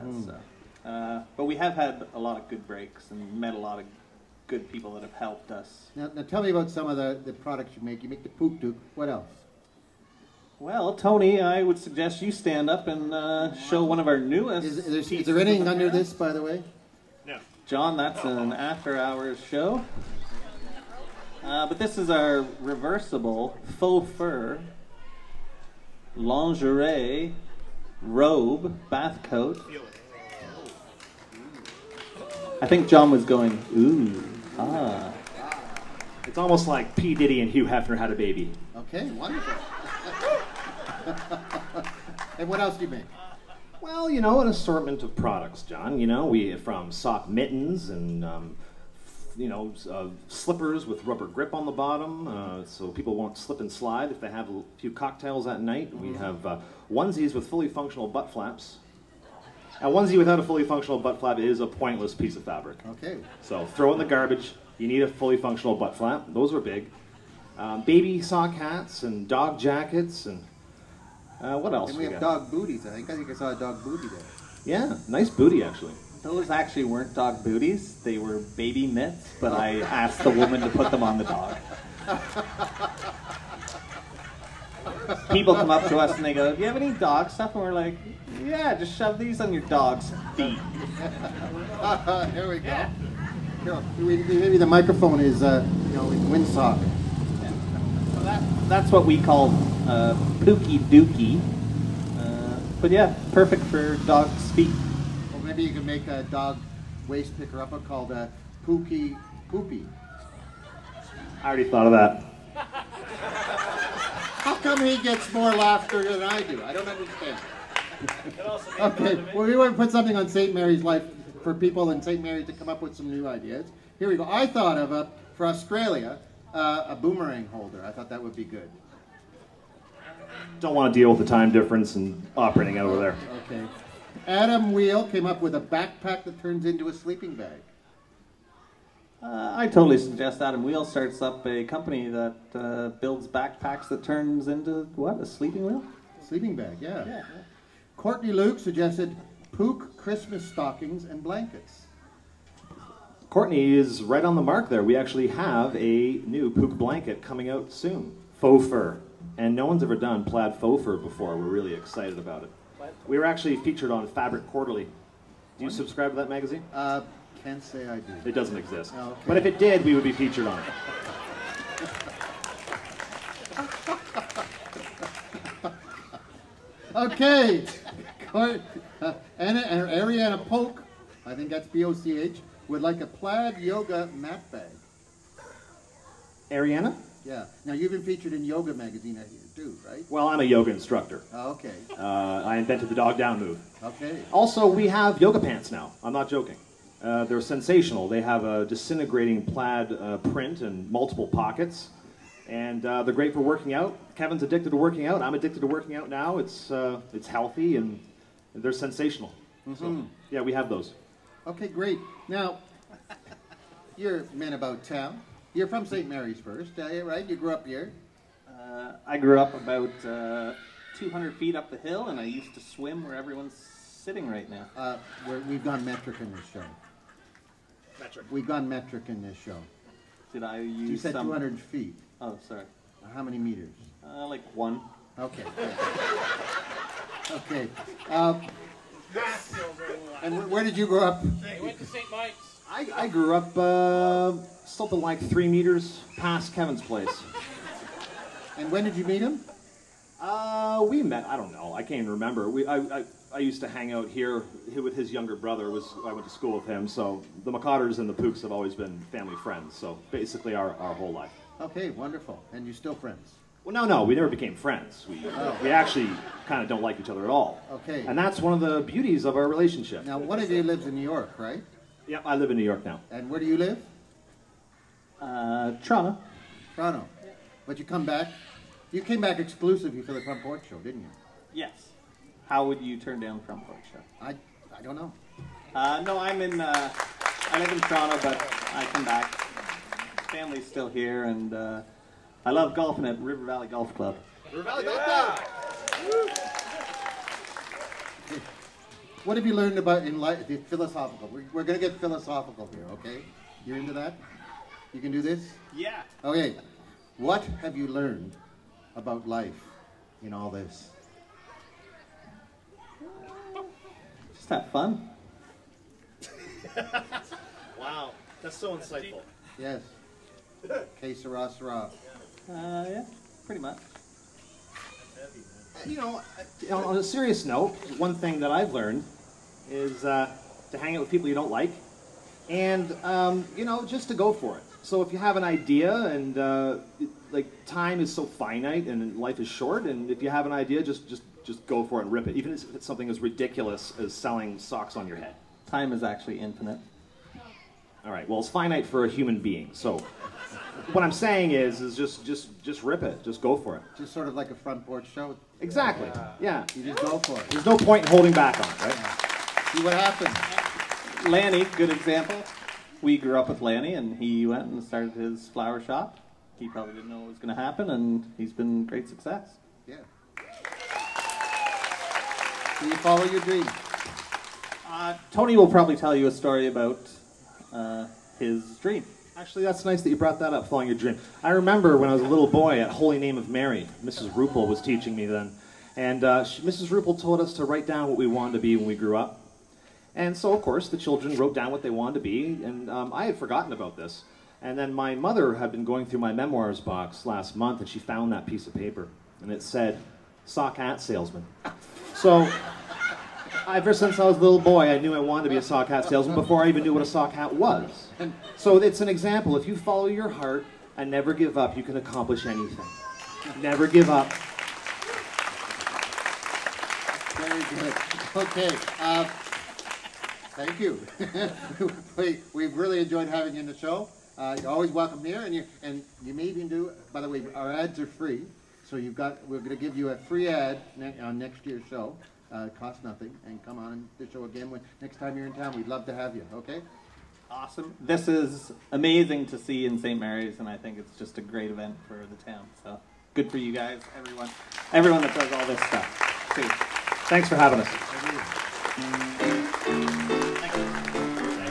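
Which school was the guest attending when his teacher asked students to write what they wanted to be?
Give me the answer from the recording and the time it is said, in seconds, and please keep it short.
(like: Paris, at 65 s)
Holy Name of Mary, at 382 s.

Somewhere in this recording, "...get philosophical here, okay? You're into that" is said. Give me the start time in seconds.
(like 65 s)
301 s.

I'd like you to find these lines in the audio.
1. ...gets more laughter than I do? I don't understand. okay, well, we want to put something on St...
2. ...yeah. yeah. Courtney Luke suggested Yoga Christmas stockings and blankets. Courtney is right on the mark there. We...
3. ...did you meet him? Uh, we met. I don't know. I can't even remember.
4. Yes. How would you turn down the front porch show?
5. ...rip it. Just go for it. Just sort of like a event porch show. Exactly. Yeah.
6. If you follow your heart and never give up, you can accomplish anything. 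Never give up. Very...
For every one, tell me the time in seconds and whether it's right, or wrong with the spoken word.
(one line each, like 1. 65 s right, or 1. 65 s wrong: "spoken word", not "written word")
1. 114 s right
2. 146 s wrong: "Pook", not "Yoga"
3. 248 s right
4. 281 s right
5. 352 s wrong: "front", not "event"
6. 409 s right.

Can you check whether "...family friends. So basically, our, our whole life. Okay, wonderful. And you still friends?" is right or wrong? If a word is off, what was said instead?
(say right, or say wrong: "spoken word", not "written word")
right.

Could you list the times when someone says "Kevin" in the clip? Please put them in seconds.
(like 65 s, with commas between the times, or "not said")
204 s, 246 s.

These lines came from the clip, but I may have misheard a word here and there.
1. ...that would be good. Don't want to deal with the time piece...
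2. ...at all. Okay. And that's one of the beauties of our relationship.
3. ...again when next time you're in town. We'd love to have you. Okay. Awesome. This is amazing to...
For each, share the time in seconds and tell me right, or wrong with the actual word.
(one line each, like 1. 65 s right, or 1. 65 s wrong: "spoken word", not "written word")
1. 128 s wrong: "difference", not "piece"
2. 267 s right
3. 434 s right.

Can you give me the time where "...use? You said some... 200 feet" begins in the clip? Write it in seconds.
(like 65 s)
230 s.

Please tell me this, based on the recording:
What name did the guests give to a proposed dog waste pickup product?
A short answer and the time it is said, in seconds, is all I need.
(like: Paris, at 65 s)
Pookie Poopy, at 108 s.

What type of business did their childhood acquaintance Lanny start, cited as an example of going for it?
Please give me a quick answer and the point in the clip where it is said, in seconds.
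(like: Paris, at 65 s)
Flower shop, at 365 s.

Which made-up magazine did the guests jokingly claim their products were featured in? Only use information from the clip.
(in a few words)
Fabric Quarterly.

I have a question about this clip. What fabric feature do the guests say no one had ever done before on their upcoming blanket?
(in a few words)
Plaid faux fur.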